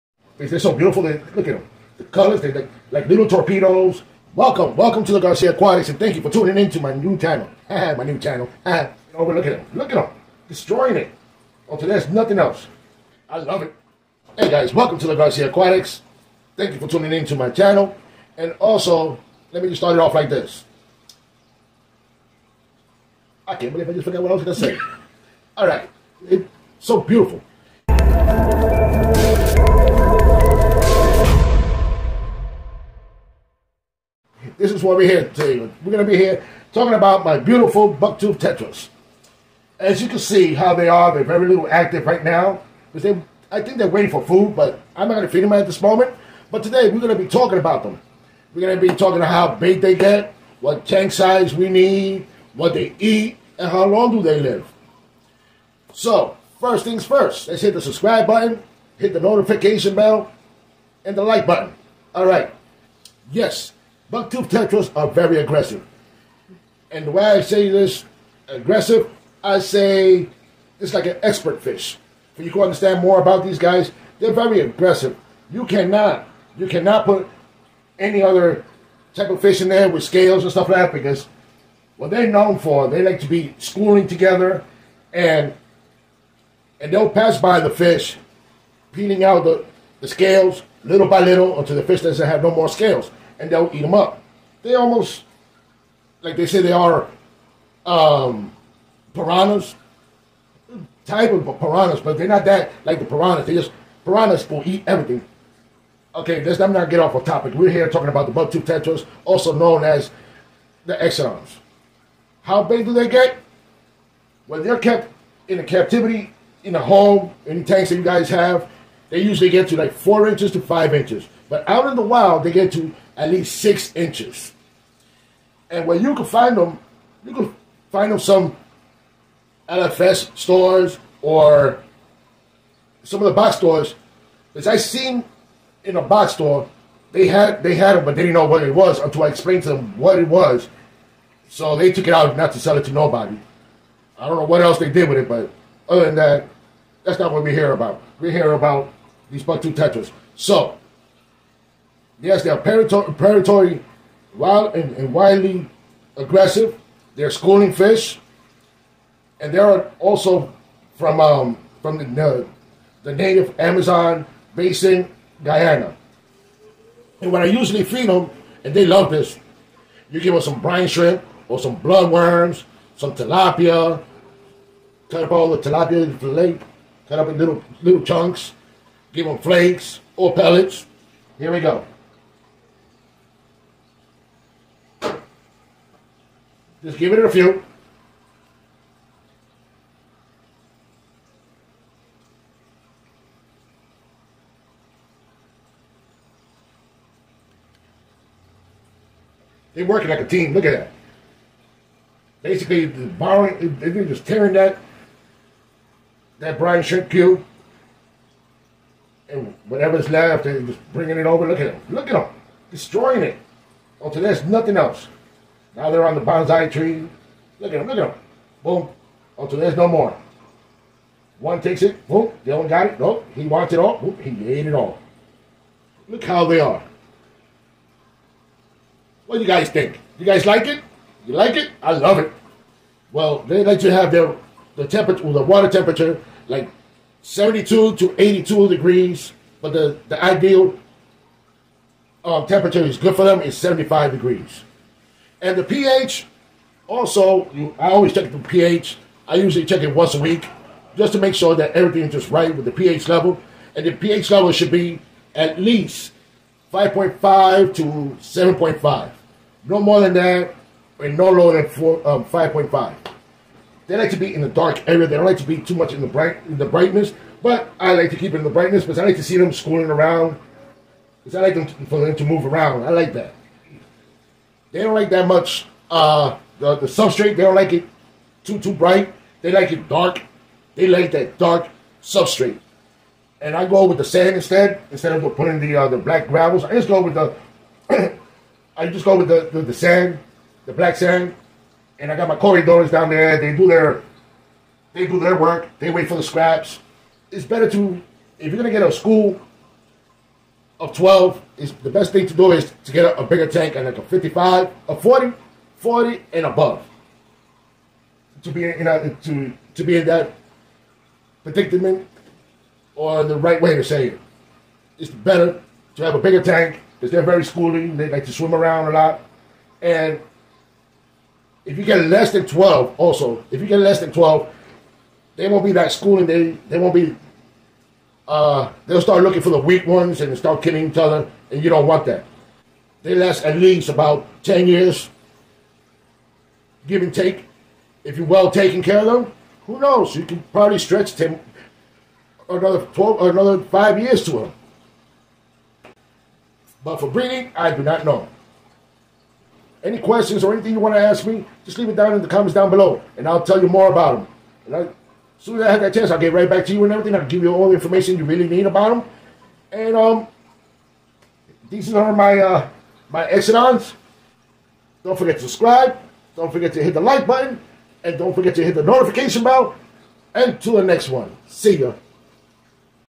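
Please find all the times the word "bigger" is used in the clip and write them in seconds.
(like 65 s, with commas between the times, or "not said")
303 s, 316 s.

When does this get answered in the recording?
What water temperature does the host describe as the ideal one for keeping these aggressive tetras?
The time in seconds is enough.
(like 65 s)
243 s.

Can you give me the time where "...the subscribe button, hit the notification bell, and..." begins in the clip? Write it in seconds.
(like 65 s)
57 s.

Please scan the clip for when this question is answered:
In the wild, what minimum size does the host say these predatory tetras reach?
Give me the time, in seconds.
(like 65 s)
123 s.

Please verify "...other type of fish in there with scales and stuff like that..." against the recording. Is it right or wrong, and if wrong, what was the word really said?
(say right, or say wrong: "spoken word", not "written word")
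right.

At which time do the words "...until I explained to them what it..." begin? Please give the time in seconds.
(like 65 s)
138 s.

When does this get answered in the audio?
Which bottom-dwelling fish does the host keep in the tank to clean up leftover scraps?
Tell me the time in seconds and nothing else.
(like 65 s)
292 s.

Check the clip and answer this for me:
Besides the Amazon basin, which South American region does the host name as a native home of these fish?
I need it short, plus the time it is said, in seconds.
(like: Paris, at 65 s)
Guyana, at 165 s.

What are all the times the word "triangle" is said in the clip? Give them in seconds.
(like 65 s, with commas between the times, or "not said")
not said.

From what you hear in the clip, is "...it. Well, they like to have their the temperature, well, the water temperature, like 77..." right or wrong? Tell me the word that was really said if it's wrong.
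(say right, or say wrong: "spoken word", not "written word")
wrong: "72", not "77".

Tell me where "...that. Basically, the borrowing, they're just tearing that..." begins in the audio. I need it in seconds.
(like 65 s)
200 s.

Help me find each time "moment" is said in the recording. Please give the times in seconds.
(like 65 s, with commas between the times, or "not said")
45 s.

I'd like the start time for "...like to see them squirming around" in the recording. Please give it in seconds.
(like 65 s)
269 s.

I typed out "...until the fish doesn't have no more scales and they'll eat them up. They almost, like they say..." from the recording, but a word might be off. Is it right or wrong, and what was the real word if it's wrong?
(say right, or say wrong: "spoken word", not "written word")
right.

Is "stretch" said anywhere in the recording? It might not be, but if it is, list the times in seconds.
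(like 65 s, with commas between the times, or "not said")
340 s.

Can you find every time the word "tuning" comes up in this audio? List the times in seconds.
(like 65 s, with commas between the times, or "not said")
6 s, 16 s.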